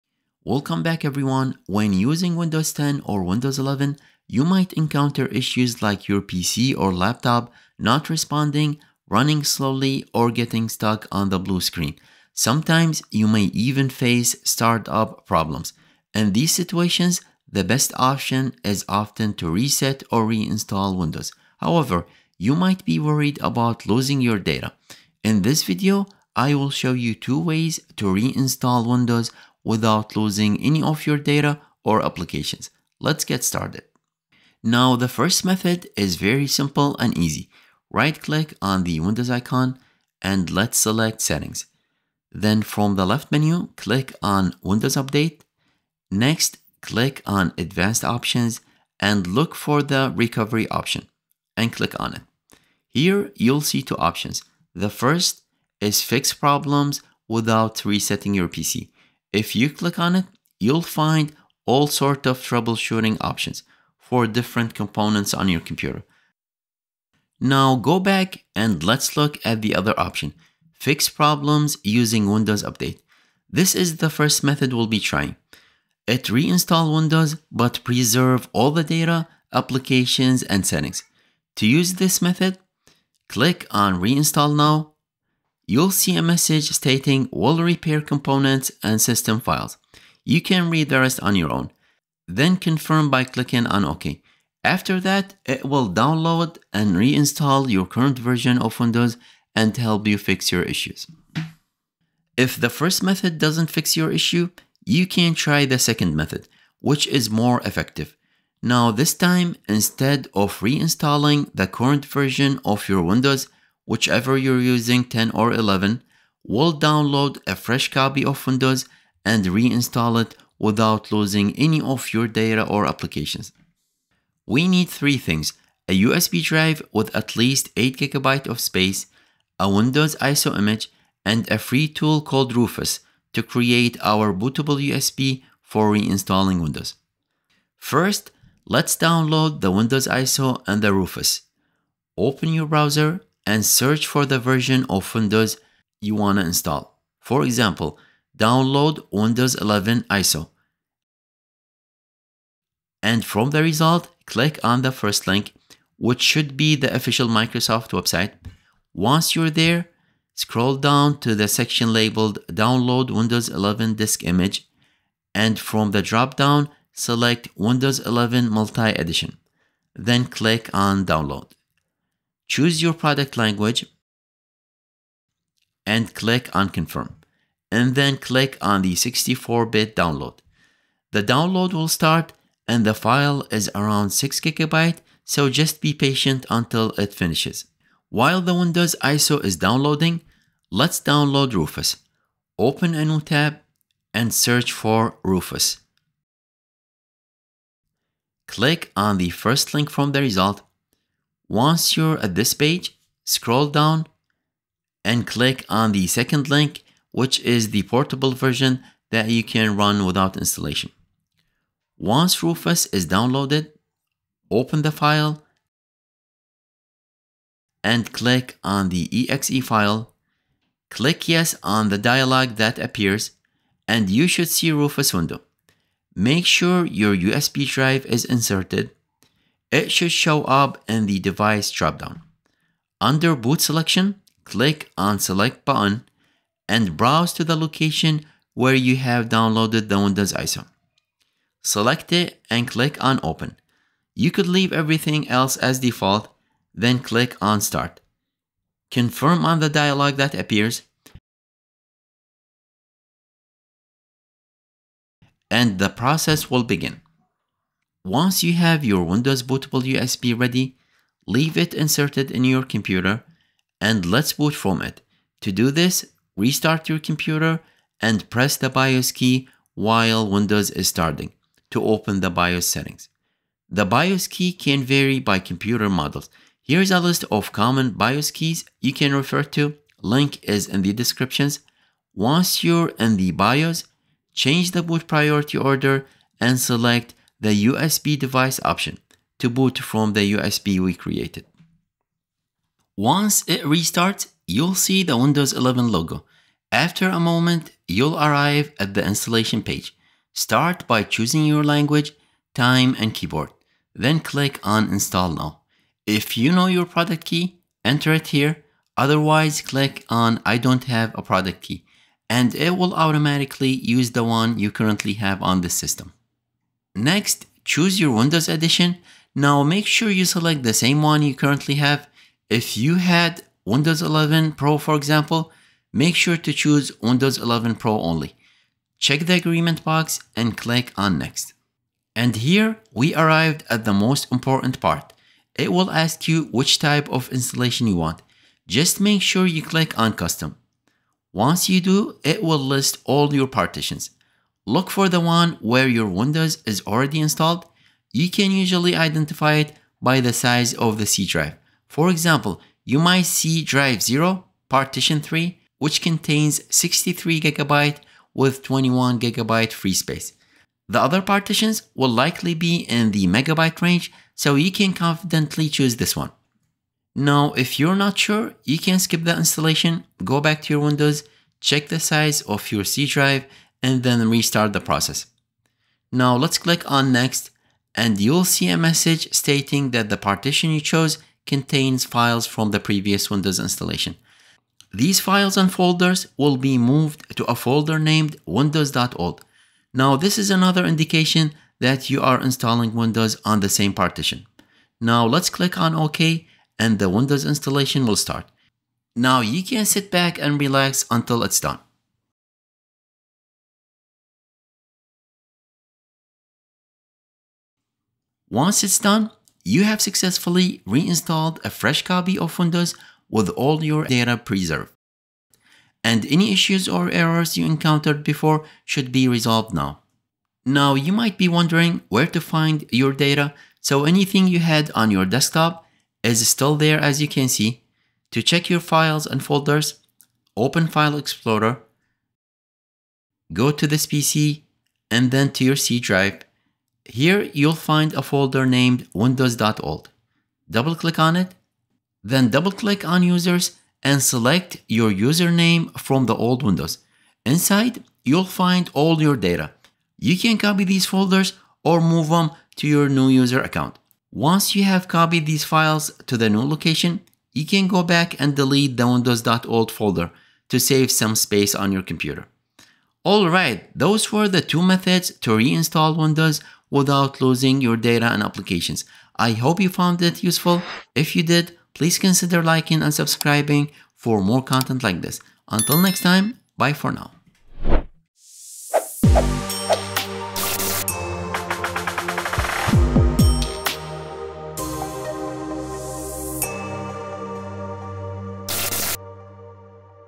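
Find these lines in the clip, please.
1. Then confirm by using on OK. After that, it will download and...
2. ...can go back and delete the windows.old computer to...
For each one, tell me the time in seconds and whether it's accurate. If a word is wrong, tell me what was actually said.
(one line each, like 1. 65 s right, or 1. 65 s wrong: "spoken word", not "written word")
1. 92 s wrong: "clicking", not "using"
2. 457 s wrong: "folder", not "computer".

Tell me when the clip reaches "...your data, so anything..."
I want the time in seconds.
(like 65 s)
422 s.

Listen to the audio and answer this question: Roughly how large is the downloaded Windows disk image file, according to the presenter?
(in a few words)
6 gigabytes.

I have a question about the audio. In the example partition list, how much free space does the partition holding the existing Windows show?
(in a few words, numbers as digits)
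21 gigabytes.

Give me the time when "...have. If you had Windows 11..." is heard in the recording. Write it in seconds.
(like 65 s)
321 s.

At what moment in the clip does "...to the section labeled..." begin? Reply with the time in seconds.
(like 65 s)
161 s.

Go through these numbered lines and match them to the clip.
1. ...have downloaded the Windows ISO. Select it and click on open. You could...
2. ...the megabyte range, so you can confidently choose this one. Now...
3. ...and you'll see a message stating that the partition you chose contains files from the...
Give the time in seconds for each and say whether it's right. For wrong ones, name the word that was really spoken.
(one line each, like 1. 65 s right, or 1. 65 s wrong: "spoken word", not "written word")
1. 238 s right
2. 363 s right
3. 377 s right.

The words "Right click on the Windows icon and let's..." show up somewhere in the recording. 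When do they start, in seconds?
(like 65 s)
37 s.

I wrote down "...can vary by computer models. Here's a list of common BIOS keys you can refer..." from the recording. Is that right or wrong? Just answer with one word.
right.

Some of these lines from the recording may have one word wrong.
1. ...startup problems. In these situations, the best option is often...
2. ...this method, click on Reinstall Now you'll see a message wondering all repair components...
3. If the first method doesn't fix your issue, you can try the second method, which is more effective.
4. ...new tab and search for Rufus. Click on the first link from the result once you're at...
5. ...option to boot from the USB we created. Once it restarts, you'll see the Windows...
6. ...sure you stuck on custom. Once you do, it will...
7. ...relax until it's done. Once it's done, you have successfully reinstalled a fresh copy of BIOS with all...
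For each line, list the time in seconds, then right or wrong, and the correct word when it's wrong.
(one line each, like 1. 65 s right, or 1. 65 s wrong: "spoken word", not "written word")
1. 14 s right
2. 81 s wrong: "stating", not "wondering"
3. 102 s right
4. 193 s right
5. 288 s right
6. 339 s wrong: "click", not "stuck"
7. 400 s wrong: "Windows", not "BIOS".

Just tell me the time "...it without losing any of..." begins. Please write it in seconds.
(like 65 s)
120 s.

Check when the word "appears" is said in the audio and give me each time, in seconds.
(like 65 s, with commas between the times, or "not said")
222 s, 250 s.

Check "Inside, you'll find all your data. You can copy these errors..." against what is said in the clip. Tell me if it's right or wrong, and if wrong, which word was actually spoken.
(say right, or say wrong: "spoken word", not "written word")
wrong: "folders", not "errors".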